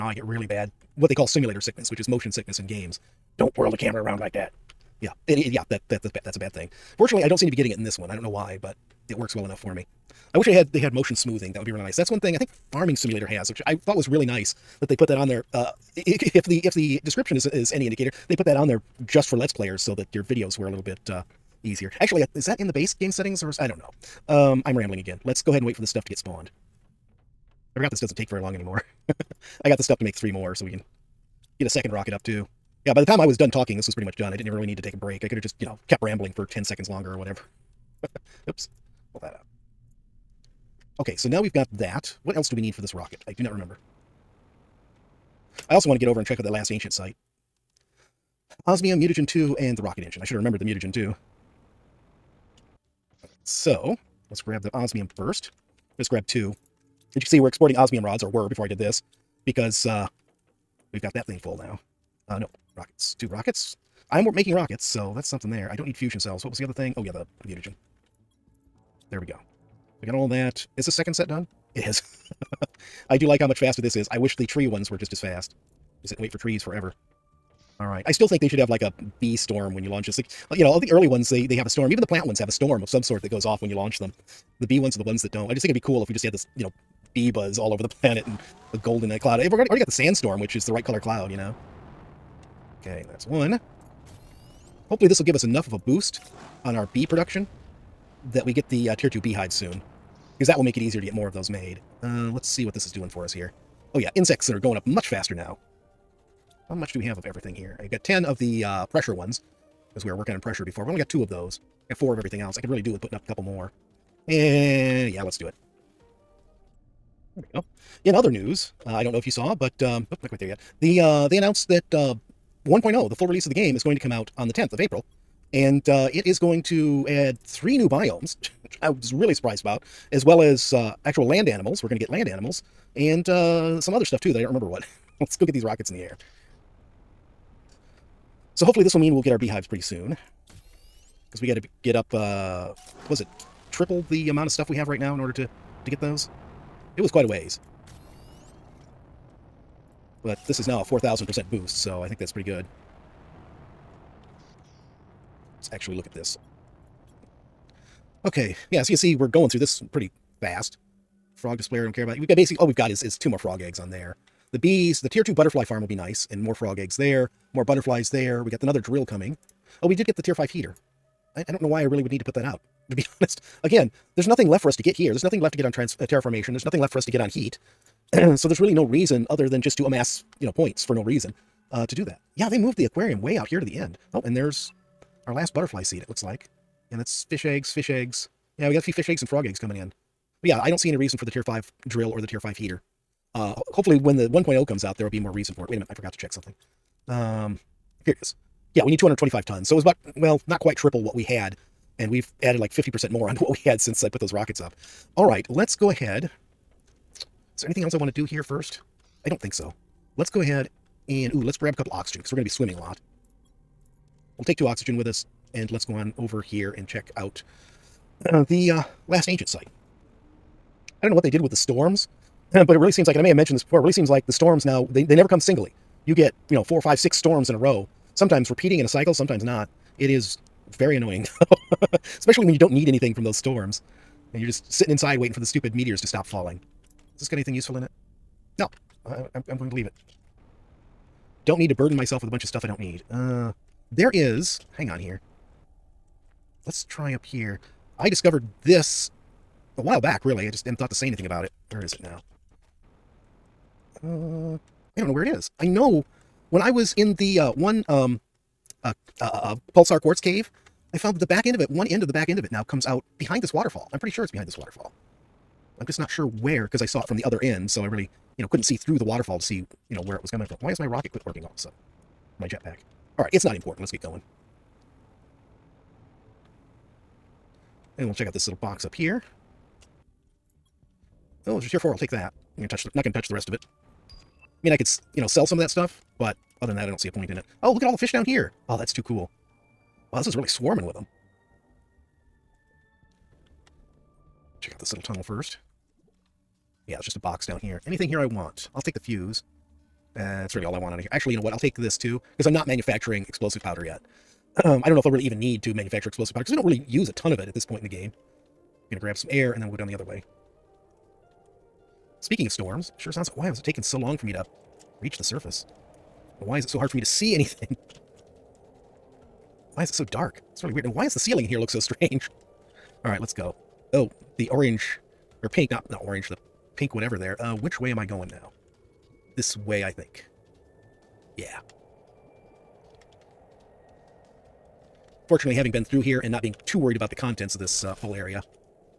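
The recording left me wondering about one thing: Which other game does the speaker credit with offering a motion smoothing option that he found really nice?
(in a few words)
Farming Simulator.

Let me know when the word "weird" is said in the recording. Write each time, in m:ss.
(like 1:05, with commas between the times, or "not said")
5:20.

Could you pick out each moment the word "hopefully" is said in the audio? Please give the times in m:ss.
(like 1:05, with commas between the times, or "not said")
1:34, 2:18, 3:13.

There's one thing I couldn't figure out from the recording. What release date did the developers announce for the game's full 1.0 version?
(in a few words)
April 10.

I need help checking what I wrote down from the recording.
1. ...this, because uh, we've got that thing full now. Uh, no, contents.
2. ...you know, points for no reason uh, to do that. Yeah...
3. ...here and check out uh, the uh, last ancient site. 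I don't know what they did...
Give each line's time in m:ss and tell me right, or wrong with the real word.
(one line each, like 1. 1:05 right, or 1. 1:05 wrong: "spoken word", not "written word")
1. 0:58 wrong: "rockets", not "contents"
2. 3:00 right
3. 3:36 right.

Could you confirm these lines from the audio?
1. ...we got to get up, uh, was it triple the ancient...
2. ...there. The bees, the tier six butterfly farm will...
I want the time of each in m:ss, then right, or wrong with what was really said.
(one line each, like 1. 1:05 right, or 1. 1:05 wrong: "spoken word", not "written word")
1. 2:21 wrong: "amount", not "ancient"
2. 2:43 wrong: "two", not "six".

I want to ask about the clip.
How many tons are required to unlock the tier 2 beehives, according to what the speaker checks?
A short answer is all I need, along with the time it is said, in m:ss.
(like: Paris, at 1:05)
225, at 3:18.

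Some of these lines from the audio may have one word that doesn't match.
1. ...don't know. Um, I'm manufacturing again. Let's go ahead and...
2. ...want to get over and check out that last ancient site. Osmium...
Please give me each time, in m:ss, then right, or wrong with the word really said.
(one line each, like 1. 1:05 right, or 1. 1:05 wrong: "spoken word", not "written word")
1. 0:23 wrong: "rambling", not "manufacturing"
2. 0:45 right.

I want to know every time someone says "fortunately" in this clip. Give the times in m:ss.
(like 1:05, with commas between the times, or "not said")
0:06, 5:35.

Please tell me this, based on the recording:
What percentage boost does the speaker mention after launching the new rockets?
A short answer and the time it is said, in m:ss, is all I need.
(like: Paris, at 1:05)
4,000%, at 2:30.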